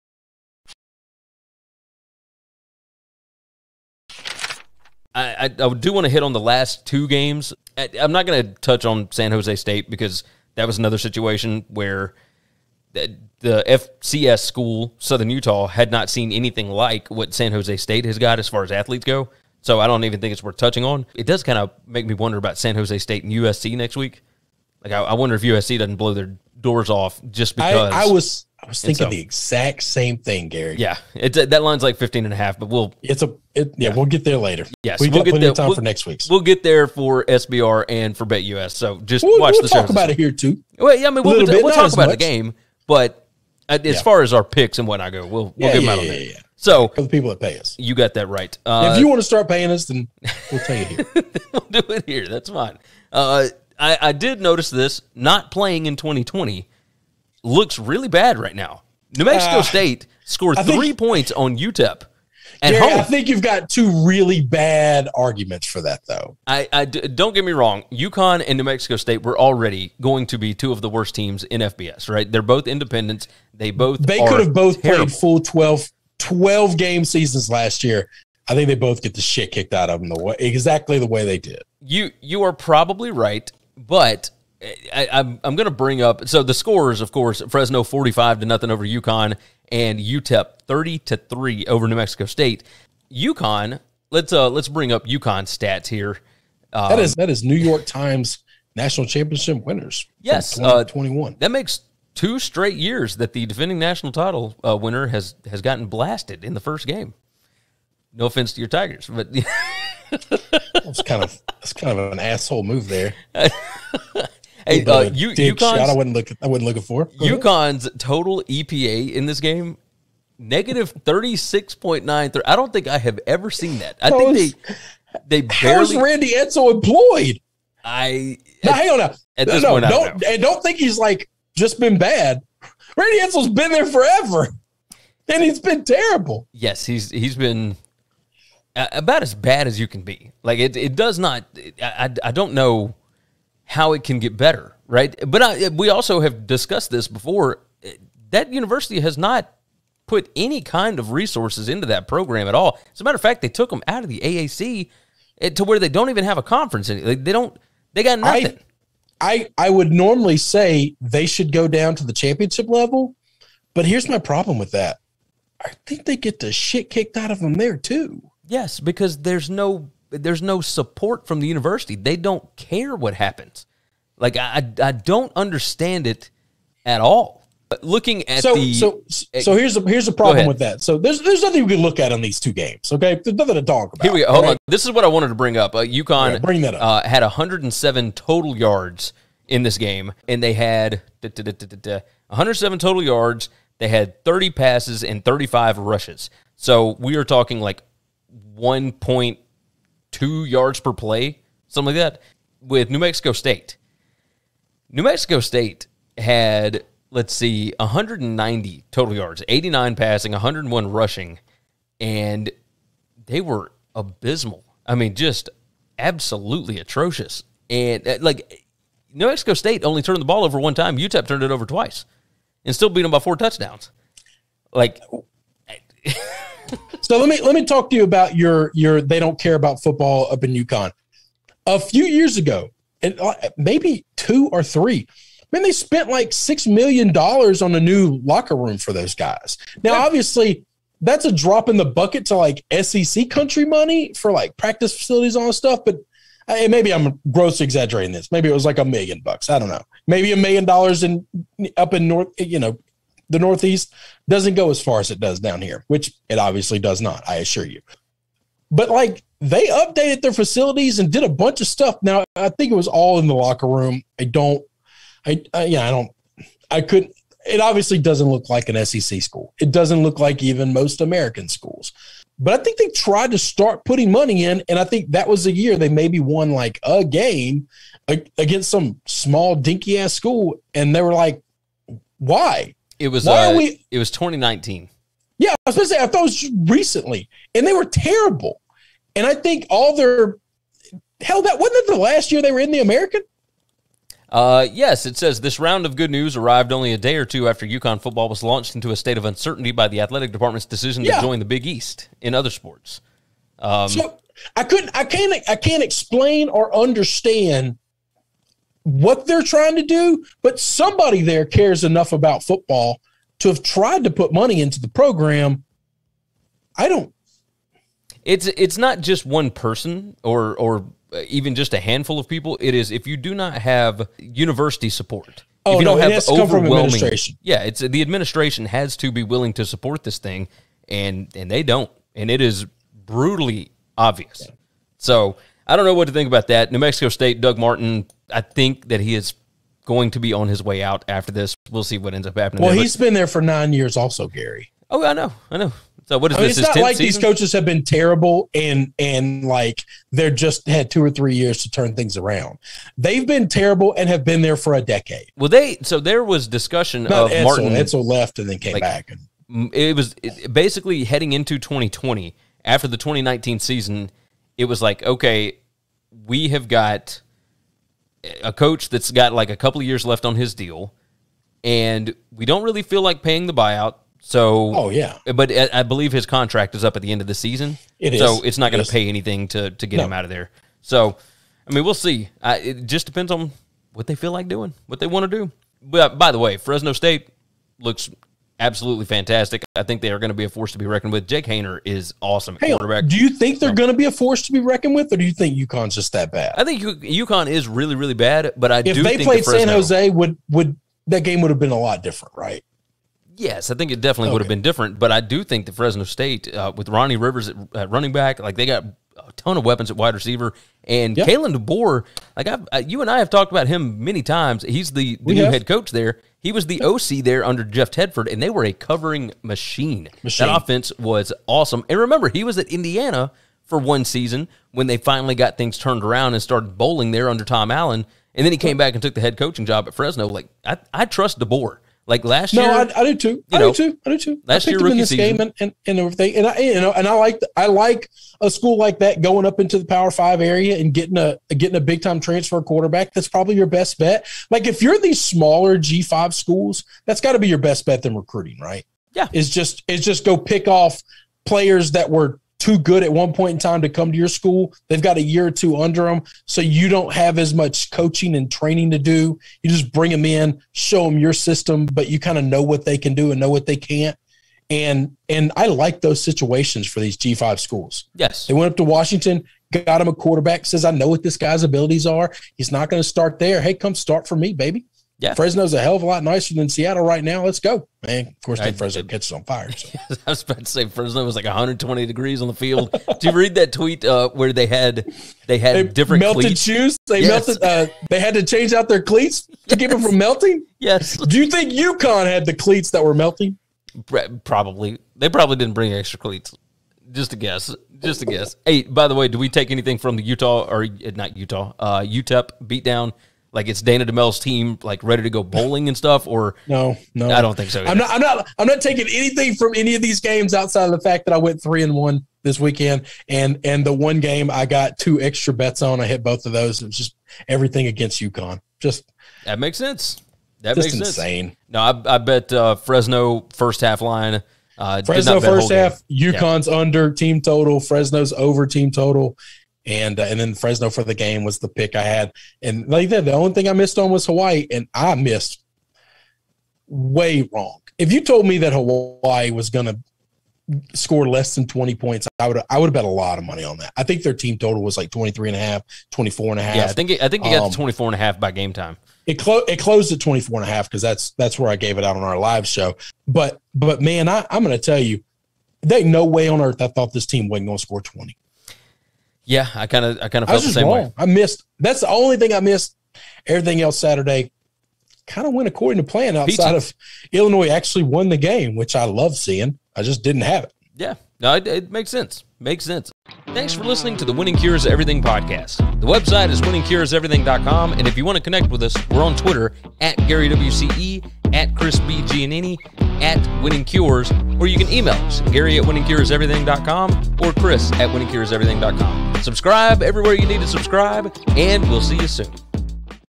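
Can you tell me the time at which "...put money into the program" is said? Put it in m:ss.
5:14.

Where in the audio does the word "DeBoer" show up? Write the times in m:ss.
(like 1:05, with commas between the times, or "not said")
6:51, 7:11.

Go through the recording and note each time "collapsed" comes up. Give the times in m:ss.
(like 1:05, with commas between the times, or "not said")
not said.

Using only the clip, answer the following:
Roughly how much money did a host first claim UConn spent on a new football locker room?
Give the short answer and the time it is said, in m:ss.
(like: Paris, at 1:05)
$6 million, at 3:56.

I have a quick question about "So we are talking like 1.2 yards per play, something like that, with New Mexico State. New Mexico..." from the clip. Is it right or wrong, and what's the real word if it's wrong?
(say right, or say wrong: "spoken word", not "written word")
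right.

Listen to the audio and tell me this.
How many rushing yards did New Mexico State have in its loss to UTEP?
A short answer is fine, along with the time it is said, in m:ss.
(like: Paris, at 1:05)
101, at 3:30.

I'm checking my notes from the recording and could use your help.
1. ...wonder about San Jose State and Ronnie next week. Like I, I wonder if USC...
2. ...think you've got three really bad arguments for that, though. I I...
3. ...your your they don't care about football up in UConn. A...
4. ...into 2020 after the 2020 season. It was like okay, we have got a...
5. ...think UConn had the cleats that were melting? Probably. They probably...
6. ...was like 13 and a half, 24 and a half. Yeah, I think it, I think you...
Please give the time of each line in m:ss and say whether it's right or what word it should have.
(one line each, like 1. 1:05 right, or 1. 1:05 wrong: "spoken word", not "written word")
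1. 0:22 wrong: "USC", not "Ronnie"
2. 1:03 wrong: "two", not "three"
3. 3:48 right
4. 6:01 wrong: "2019", not "2020"
5. 8:11 right
6. 9:04 wrong: "23", not "13".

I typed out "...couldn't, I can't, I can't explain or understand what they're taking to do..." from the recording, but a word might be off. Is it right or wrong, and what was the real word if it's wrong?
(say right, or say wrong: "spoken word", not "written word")
wrong: "trying", not "taking".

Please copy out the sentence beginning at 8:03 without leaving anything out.
Did you read that tweet uh, where they had they had they different melted cleats?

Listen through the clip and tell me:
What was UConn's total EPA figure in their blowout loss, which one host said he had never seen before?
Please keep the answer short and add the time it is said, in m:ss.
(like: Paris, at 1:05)
-36.93, at 2:00.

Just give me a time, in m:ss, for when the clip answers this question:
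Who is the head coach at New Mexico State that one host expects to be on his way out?
5:37.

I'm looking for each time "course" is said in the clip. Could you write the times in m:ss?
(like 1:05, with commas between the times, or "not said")
1:27, 7:58.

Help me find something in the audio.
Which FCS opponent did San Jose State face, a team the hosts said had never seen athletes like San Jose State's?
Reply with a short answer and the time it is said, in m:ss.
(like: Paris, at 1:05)
Southern Utah, at 0:14.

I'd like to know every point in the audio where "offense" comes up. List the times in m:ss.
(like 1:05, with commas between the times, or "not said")
1:48, 7:00.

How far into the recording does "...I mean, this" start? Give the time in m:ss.
5:46.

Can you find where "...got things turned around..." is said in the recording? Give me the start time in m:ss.
7:05.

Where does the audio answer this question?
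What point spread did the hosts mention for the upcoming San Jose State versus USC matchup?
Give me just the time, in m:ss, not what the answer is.
0:31.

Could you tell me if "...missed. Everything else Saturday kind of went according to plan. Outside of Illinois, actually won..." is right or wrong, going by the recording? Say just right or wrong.
right.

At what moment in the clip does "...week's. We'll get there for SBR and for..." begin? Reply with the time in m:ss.
0:36.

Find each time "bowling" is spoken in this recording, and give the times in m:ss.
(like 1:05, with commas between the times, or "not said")
7:06, 8:25.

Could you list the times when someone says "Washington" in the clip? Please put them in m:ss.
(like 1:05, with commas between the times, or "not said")
7:48.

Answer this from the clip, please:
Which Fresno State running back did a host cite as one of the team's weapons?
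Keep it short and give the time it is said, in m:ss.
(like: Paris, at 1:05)
Ronnie Rivers, at 6:46.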